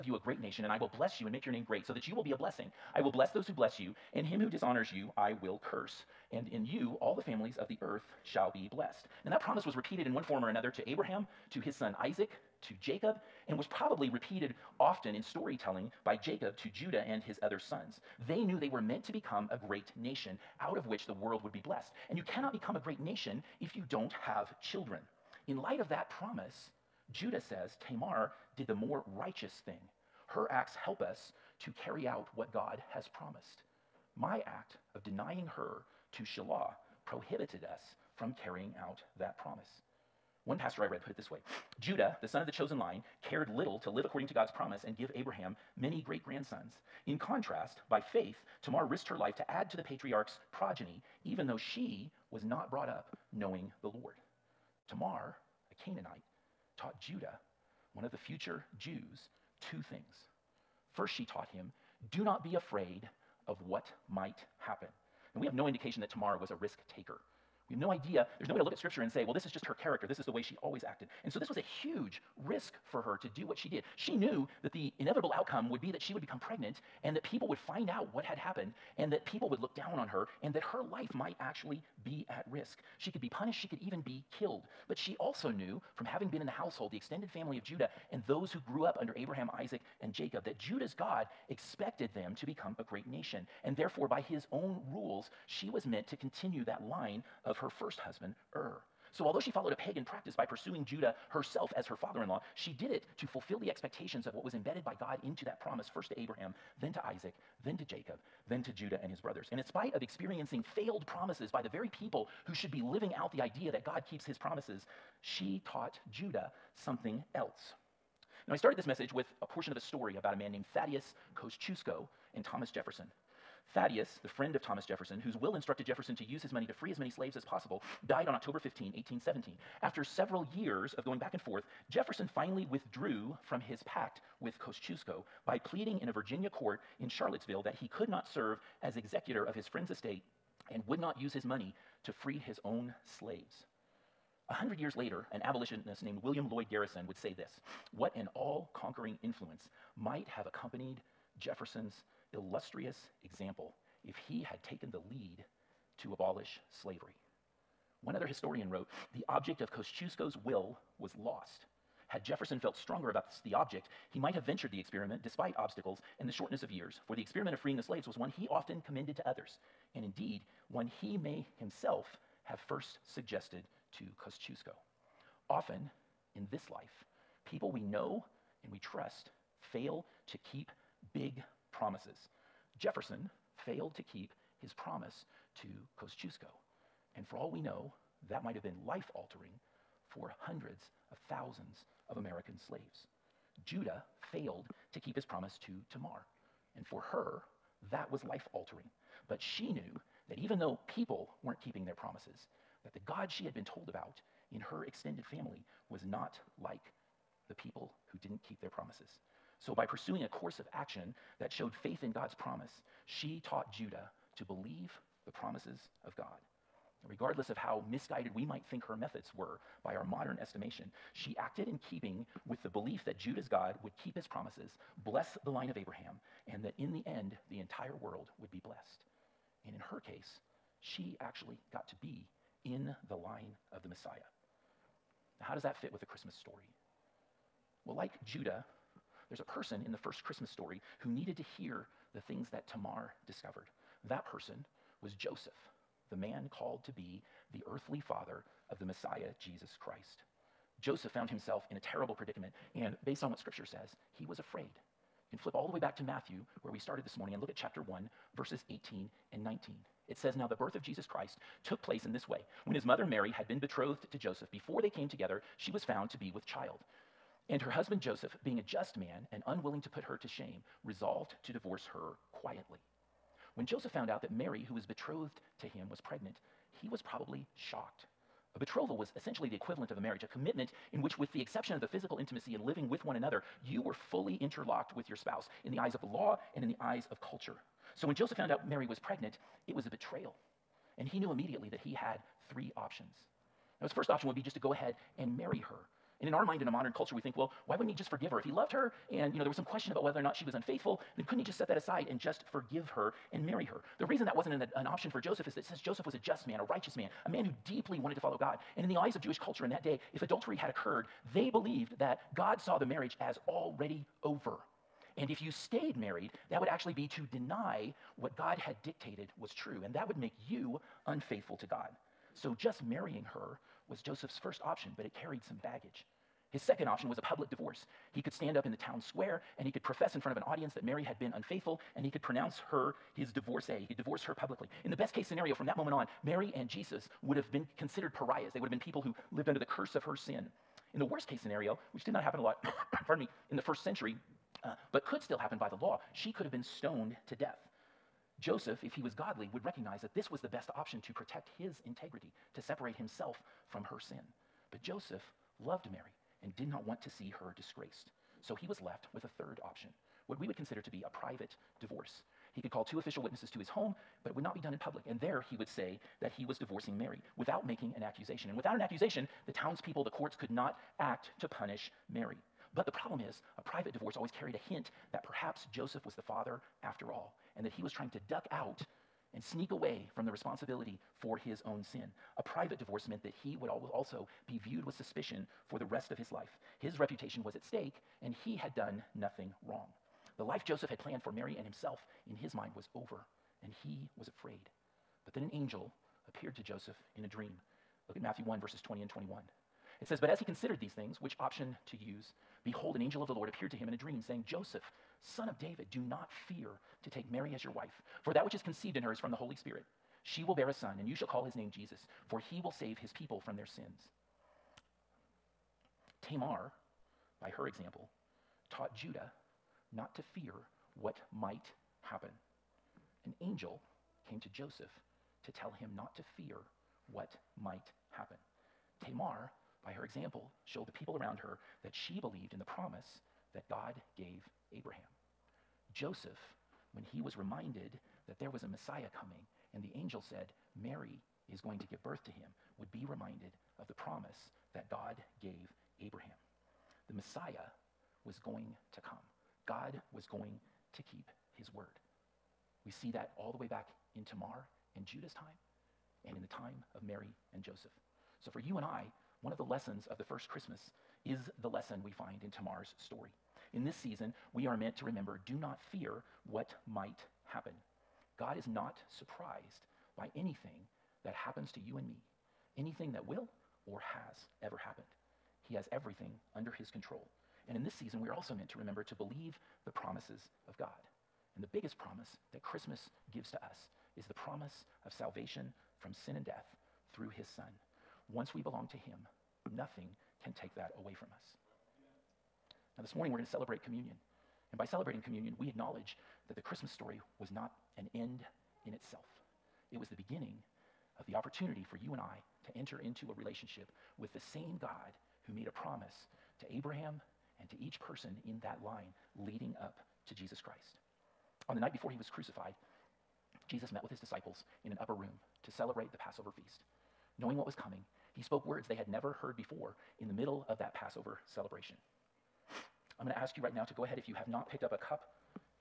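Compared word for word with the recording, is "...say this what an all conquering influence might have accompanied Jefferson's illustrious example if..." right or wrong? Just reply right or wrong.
right.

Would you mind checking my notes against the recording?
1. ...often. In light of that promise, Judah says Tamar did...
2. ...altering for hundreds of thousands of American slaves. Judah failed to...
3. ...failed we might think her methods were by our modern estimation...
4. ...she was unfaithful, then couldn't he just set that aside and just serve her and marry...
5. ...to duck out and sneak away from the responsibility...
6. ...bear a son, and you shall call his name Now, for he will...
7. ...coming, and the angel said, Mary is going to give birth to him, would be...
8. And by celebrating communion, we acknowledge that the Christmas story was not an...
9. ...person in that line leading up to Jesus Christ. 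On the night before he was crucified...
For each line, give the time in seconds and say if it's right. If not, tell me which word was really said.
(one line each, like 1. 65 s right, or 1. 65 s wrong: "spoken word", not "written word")
1. 24 s wrong: "children", not "often"
2. 189 s right
3. 217 s wrong: "misguided", not "failed"
4. 300 s wrong: "forgive", not "serve"
5. 378 s right
6. 410 s wrong: "Jesus", not "Now"
7. 439 s right
8. 494 s right
9. 508 s right.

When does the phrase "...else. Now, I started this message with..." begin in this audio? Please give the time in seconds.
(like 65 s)
117 s.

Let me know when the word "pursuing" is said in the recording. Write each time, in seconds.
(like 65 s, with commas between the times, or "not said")
100 s, 209 s.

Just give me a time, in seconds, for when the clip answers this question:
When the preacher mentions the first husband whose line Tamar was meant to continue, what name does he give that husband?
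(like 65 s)
98 s.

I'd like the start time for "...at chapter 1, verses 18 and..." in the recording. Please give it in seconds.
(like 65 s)
257 s.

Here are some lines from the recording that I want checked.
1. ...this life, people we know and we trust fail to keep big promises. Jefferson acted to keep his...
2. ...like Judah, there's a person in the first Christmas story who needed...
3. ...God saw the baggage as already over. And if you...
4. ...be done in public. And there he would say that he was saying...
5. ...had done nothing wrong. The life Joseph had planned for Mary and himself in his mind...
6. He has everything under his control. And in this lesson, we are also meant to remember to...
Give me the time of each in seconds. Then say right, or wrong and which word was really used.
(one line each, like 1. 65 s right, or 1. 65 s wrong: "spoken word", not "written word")
1. 176 s wrong: "failed", not "acted"
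2. 237 s right
3. 312 s wrong: "marriage", not "baggage"
4. 364 s wrong: "divorcing", not "saying"
5. 388 s right
6. 475 s wrong: "season", not "lesson".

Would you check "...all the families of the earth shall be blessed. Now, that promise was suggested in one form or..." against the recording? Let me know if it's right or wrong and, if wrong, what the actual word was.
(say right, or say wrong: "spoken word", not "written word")
wrong: "repeated", not "suggested".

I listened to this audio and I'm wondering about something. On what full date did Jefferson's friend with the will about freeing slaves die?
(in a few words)
October 15, 1817.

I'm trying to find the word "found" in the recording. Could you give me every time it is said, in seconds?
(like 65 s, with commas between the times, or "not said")
251 s, 265 s, 273 s, 288 s.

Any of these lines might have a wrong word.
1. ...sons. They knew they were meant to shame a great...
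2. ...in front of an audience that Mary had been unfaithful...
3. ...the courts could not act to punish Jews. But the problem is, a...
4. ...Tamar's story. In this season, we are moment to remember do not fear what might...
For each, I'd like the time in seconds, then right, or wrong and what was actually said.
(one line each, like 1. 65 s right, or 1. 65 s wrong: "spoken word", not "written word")
1. 17 s wrong: "become", not "shame"
2. 330 s right
3. 370 s wrong: "Mary", not "Jews"
4. 462 s wrong: "meant", not "moment".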